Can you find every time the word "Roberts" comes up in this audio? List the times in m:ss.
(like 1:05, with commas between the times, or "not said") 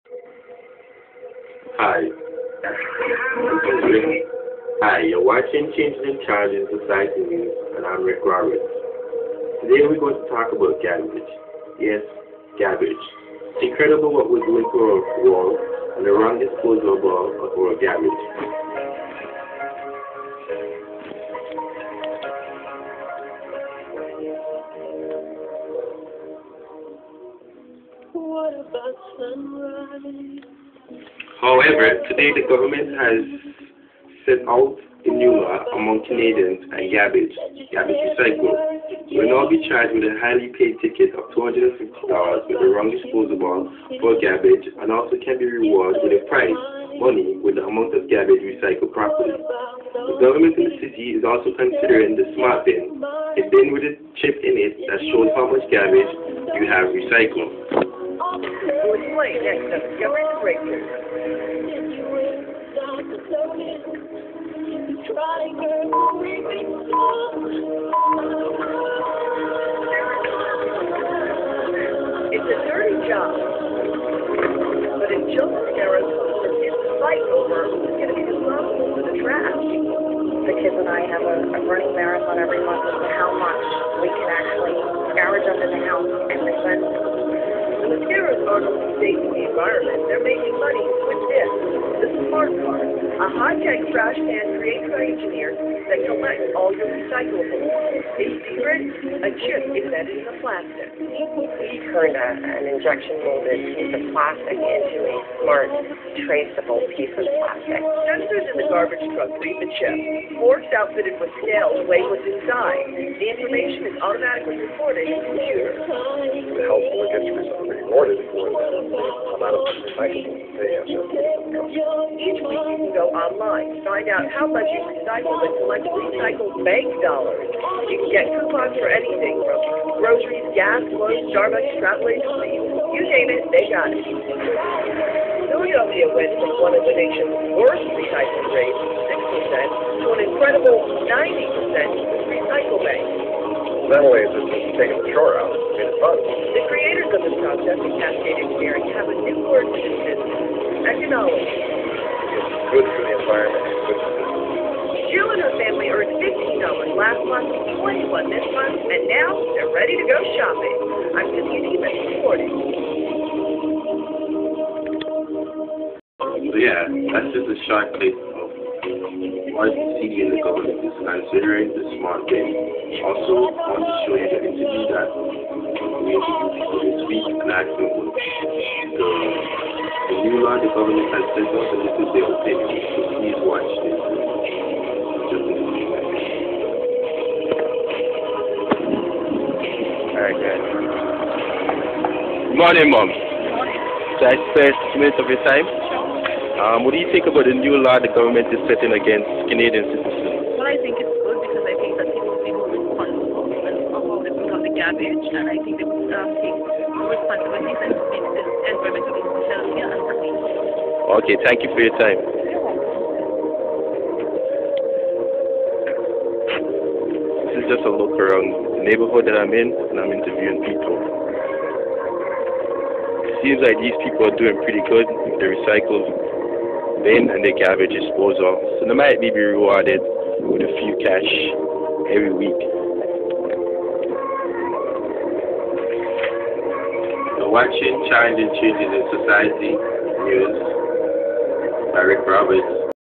0:08, 4:02.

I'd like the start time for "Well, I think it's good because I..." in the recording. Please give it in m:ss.
3:20.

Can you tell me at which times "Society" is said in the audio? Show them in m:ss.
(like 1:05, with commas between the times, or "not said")
0:06, 3:59.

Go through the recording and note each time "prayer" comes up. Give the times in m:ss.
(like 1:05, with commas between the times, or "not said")
not said.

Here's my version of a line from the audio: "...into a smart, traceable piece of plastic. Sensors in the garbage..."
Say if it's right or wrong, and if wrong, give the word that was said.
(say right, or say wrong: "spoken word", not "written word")
right.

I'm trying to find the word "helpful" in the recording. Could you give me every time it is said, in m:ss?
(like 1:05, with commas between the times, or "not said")
1:56.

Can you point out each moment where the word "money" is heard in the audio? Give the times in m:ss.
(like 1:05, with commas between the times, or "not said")
0:47, 1:30.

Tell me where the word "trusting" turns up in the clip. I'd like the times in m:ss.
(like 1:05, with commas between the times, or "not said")
not said.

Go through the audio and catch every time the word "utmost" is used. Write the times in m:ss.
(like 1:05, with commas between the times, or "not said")
not said.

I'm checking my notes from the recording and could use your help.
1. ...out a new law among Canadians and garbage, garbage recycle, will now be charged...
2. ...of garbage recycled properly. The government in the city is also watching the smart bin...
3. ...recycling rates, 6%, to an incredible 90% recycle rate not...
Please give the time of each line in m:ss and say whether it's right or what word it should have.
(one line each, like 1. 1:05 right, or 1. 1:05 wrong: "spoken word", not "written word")
1. 0:34 right
2. 0:47 wrong: "considering", not "watching"
3. 2:17 right.